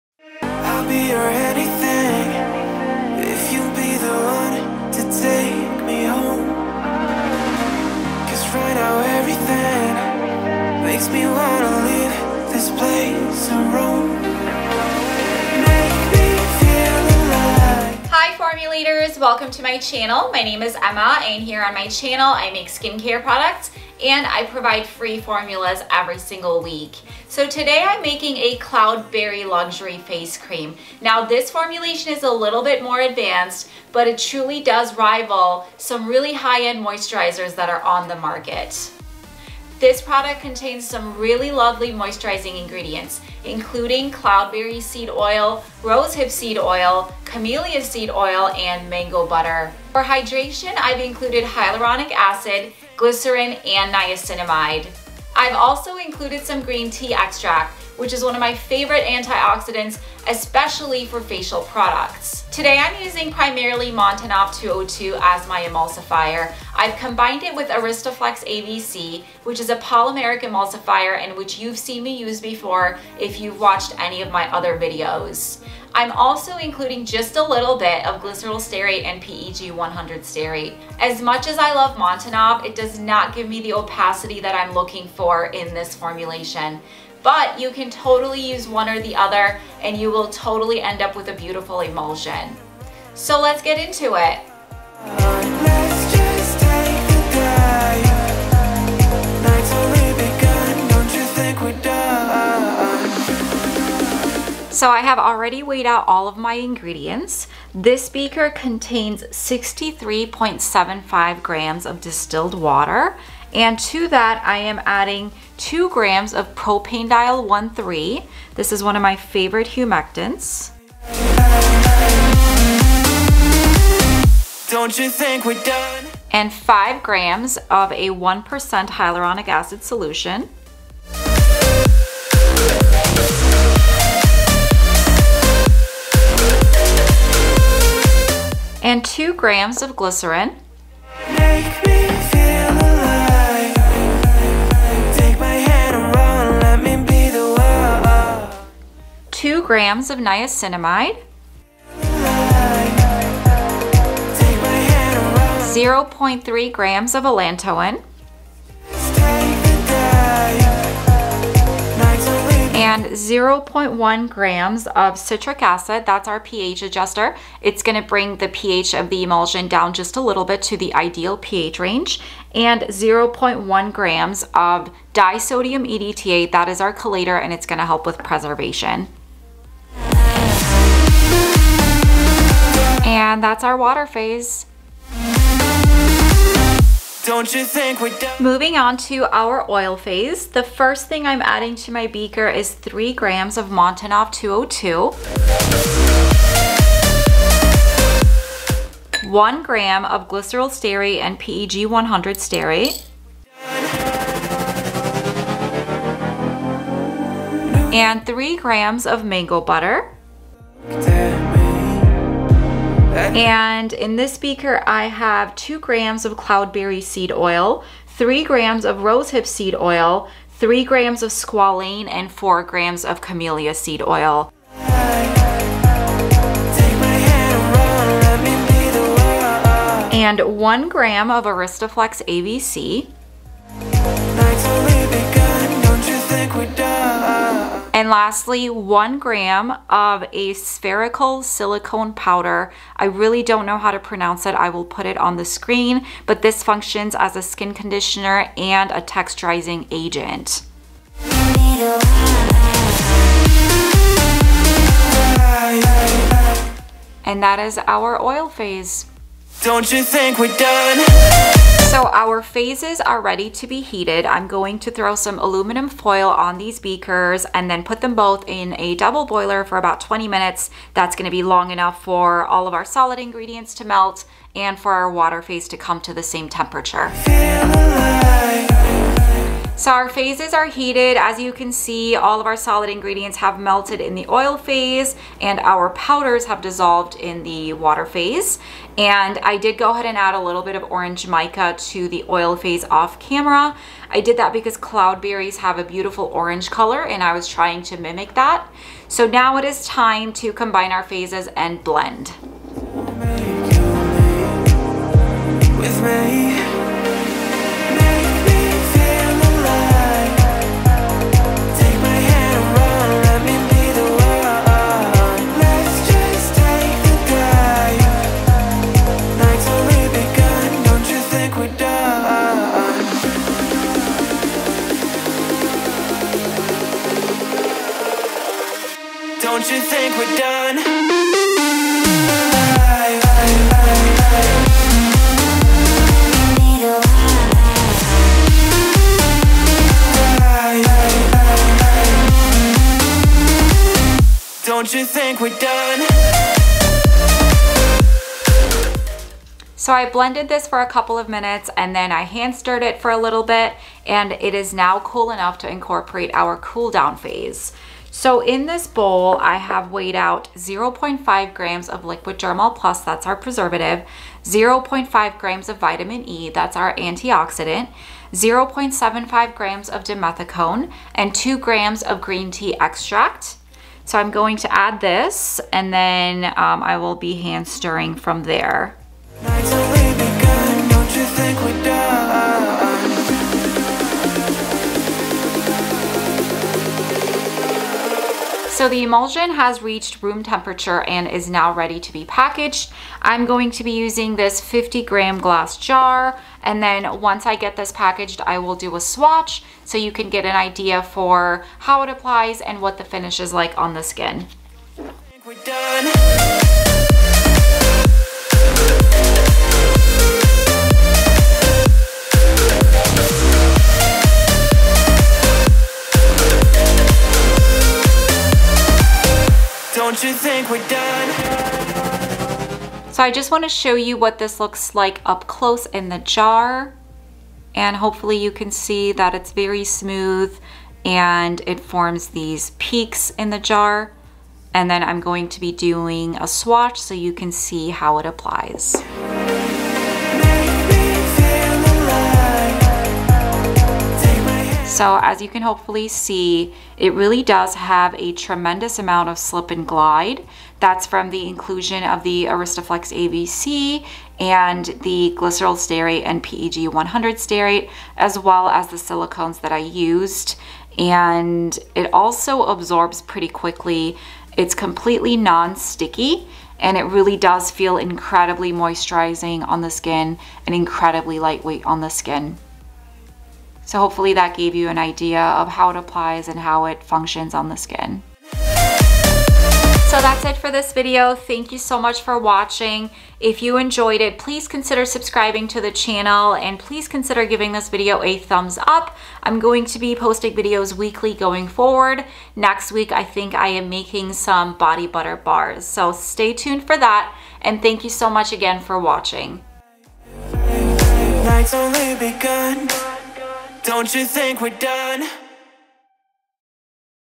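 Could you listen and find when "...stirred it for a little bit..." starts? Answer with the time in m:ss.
5:52.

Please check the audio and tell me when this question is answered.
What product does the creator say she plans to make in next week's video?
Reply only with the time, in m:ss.
8:14.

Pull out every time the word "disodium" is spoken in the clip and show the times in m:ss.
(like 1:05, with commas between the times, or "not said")
2:55.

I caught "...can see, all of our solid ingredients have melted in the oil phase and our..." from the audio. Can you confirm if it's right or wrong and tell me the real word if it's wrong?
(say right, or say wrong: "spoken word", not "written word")
right.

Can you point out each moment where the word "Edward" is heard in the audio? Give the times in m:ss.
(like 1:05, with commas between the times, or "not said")
not said.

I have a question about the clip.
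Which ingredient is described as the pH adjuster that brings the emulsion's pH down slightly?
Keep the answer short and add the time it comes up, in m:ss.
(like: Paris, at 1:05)
citric acid, at 2:45.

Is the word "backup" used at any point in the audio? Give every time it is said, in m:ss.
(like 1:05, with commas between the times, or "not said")
not said.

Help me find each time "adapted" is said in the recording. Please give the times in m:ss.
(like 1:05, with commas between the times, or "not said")
not said.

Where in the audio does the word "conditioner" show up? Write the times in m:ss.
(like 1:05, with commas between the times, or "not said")
4:07.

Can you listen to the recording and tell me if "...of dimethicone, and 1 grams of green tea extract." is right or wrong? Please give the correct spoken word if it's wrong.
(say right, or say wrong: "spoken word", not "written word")
wrong: "2", not "1".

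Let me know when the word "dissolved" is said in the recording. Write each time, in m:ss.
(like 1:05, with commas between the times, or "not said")
4:46.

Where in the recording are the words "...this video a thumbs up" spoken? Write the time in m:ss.
8:07.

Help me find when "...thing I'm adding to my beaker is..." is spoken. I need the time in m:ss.
3:11.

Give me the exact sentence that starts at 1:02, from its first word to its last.
Today I'm using primarily Montanov 202 as my emulsifier.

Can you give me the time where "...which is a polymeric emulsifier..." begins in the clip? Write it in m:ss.
1:09.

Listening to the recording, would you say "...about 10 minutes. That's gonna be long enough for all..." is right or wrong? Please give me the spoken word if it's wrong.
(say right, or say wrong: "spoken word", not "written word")
wrong: "20", not "10".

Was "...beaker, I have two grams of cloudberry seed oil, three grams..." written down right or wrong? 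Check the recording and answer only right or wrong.
right.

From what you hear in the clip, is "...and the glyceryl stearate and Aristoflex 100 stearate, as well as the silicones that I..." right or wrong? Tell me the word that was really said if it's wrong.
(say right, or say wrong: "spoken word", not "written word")
wrong: "PEG", not "Aristoflex".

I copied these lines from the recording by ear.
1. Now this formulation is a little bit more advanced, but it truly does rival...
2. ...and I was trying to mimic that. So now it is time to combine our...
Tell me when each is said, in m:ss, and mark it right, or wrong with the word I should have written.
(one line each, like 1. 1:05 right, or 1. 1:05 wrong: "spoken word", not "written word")
1. 0:31 right
2. 4:57 right.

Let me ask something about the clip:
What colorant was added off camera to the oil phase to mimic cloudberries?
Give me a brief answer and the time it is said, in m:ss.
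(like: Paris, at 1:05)
orange mica, at 4:50.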